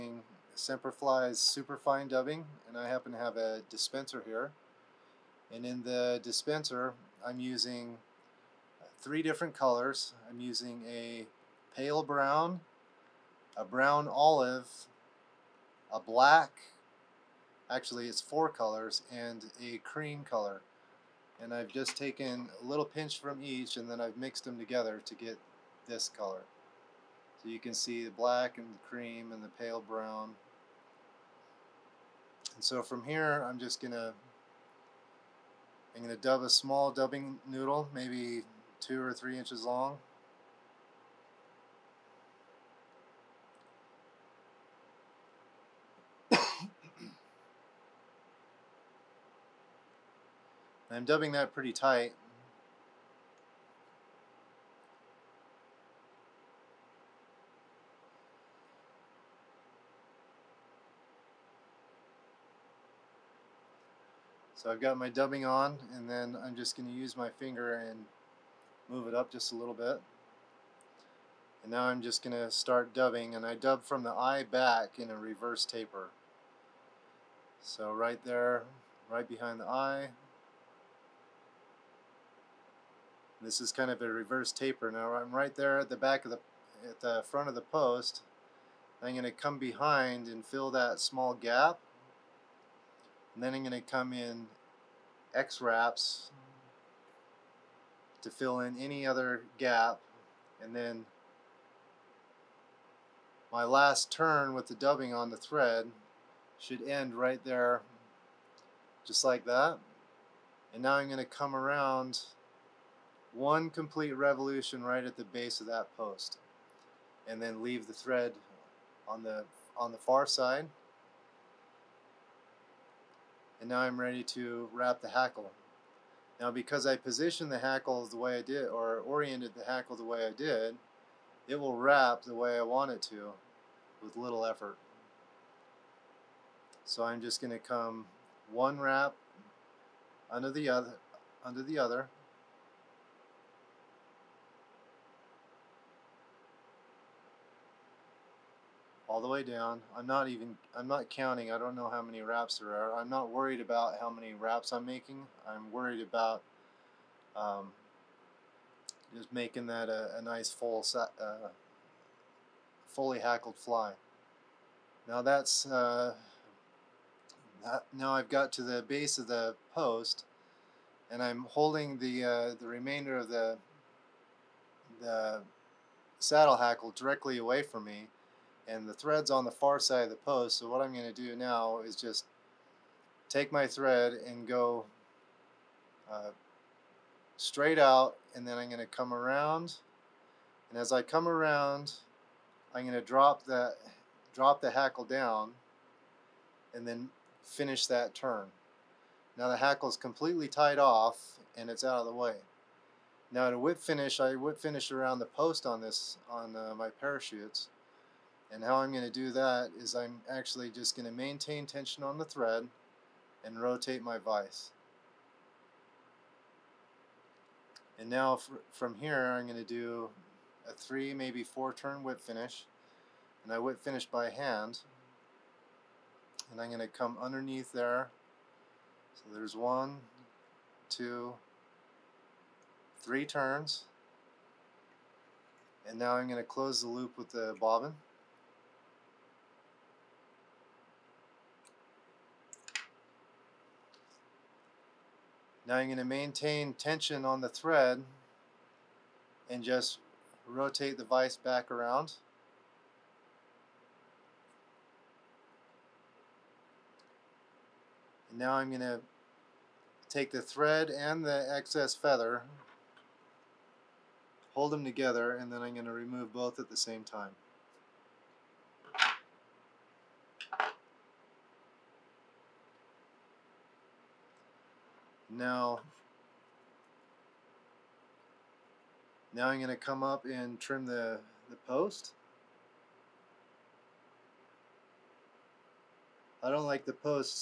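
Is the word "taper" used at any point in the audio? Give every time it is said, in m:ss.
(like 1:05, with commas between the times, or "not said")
1:15, 1:24.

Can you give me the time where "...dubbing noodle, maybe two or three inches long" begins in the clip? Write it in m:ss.
0:36.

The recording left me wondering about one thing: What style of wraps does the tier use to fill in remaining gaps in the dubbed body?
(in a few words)
X wraps.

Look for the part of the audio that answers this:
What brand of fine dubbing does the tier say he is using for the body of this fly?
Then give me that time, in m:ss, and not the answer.
0:00.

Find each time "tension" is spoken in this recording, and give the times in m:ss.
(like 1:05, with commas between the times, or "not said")
3:31, 4:06.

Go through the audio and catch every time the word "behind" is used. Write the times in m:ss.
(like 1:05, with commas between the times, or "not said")
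1:19, 1:29.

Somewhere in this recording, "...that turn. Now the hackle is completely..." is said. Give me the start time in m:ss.
3:17.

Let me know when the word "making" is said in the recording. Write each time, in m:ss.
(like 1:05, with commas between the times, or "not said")
2:34, 2:39.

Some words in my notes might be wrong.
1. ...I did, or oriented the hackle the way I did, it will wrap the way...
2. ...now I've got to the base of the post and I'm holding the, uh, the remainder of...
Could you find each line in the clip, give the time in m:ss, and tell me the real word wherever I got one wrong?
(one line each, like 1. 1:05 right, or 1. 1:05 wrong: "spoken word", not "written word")
1. 2:08 right
2. 2:47 right.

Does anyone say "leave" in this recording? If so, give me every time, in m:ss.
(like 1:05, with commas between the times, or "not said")
1:57.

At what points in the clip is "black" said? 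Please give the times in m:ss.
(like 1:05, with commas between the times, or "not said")
0:15, 0:28.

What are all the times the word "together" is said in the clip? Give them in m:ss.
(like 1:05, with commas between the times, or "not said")
0:24, 4:24.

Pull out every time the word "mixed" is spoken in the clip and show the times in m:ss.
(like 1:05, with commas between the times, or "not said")
0:24.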